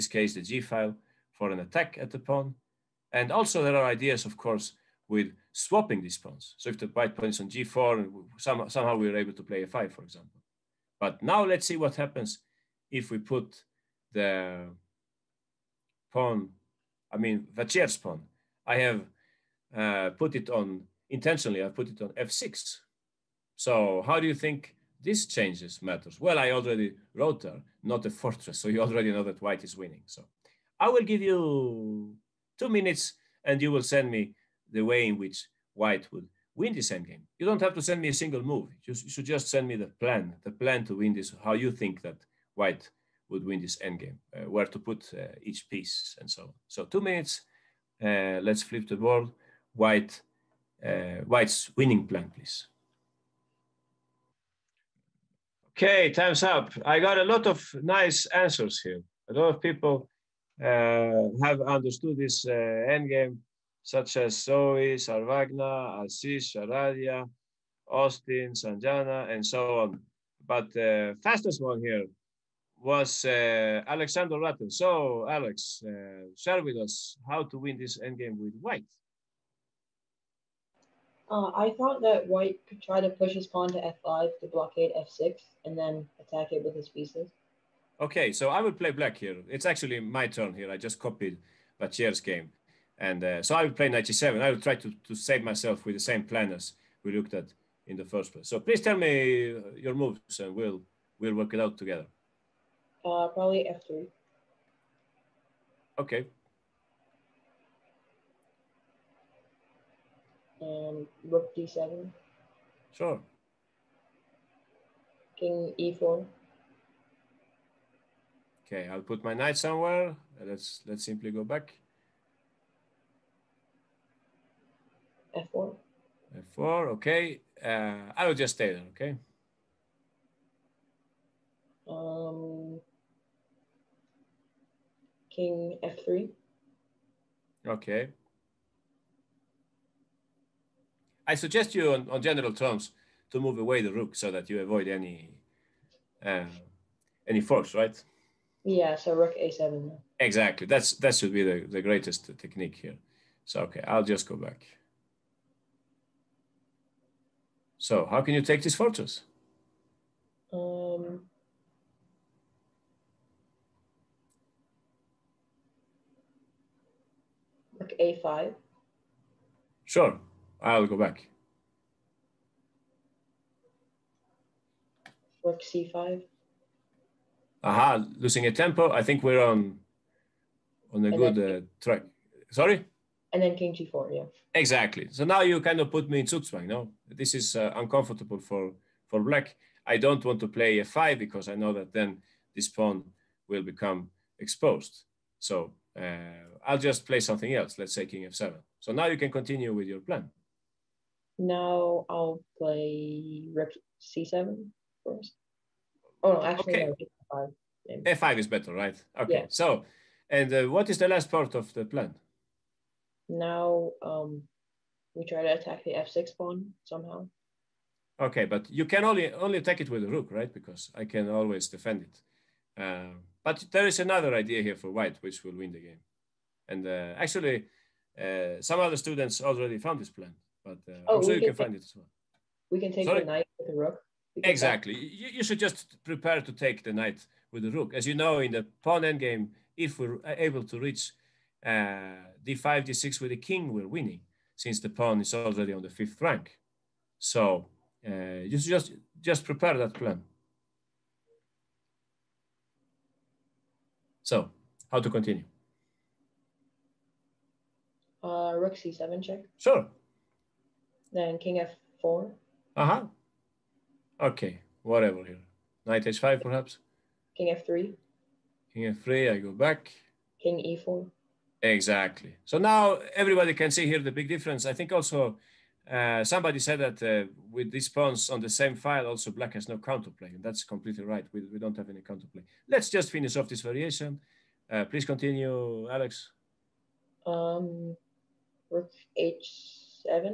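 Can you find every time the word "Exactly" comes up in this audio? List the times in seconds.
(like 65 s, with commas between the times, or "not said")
150 s, 184 s, 234 s, 271 s.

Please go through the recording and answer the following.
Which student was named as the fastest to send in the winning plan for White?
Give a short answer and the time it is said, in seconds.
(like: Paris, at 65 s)
Alexander Ratten, at 73 s.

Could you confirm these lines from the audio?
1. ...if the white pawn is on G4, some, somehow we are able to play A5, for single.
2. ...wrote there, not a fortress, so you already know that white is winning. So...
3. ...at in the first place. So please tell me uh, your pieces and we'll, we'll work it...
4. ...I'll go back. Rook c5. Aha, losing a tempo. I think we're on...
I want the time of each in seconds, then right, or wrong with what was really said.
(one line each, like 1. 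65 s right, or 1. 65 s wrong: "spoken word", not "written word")
1. 6 s wrong: "example", not "single"
2. 27 s right
3. 97 s wrong: "moves", not "pieces"
4. 170 s right.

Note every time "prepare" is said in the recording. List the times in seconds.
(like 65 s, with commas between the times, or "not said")
236 s, 249 s.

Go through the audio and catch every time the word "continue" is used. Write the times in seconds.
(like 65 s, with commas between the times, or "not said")
199 s, 255 s, 285 s.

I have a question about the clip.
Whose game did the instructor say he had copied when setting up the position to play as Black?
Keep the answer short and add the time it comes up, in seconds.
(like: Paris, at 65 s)
Vachier, at 91 s.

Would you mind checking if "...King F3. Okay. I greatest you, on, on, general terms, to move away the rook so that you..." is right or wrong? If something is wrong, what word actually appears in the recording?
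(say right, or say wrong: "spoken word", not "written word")
wrong: "suggest", not "greatest".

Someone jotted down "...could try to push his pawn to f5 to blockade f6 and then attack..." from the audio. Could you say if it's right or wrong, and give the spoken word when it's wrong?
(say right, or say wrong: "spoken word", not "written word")
right.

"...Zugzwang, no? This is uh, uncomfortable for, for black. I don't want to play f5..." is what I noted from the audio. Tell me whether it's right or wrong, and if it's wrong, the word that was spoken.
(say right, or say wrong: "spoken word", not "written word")
right.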